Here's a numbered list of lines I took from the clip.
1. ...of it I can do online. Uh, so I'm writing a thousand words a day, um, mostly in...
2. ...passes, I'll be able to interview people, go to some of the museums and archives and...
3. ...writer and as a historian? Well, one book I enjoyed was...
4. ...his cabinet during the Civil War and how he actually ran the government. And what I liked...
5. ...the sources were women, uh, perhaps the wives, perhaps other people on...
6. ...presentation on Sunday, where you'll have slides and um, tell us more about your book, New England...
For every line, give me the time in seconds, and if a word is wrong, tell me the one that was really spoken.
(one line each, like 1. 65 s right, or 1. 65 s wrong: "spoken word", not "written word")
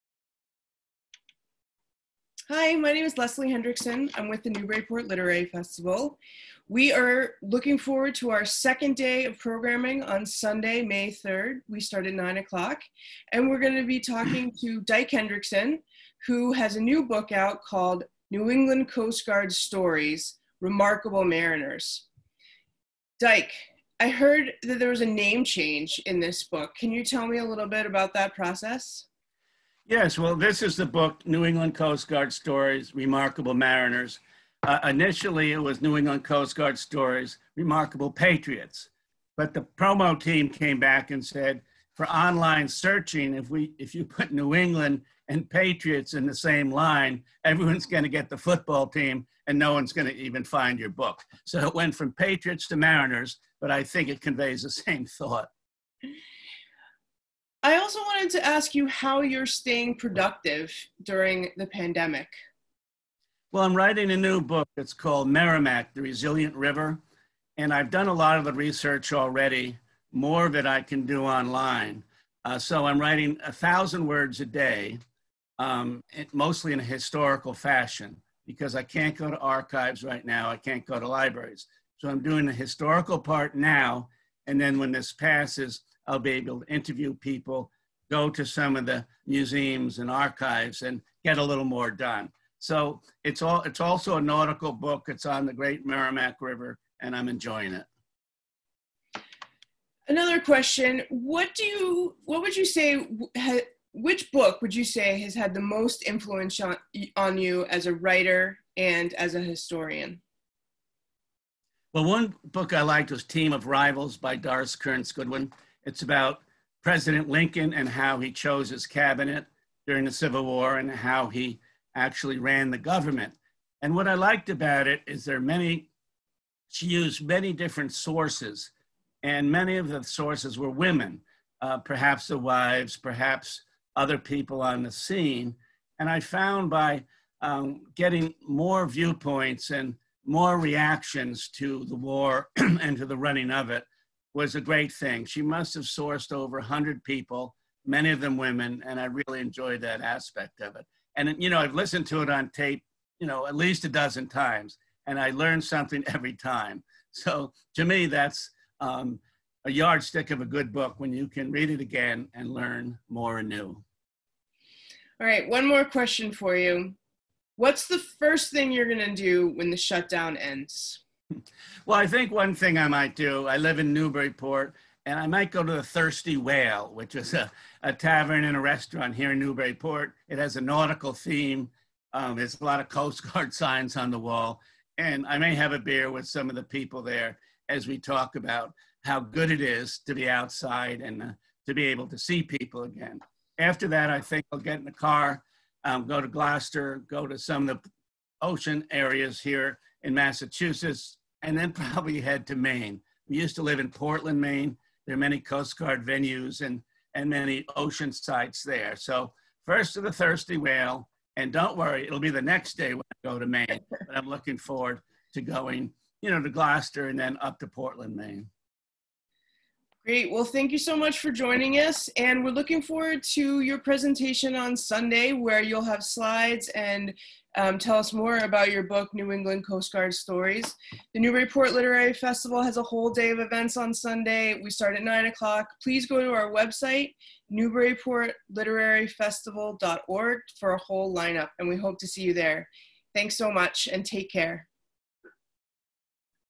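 1. 70 s right
2. 85 s right
3. 107 s wrong: "liked", not "enjoyed"
4. 118 s right
5. 129 s right
6. 223 s right.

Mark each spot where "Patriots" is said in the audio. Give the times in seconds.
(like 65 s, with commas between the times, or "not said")
38 s, 45 s, 52 s.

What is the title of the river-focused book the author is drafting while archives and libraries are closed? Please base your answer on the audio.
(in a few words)
Merrimack, The Resilient River.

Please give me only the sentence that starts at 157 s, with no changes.
So to me, that's um, a yardstick of a good book when you can read it again and learn more anew.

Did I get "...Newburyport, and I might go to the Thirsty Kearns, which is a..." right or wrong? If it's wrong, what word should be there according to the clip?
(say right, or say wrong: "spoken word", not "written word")
wrong: "Whale", not "Kearns".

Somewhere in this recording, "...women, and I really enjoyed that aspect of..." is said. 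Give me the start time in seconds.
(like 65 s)
148 s.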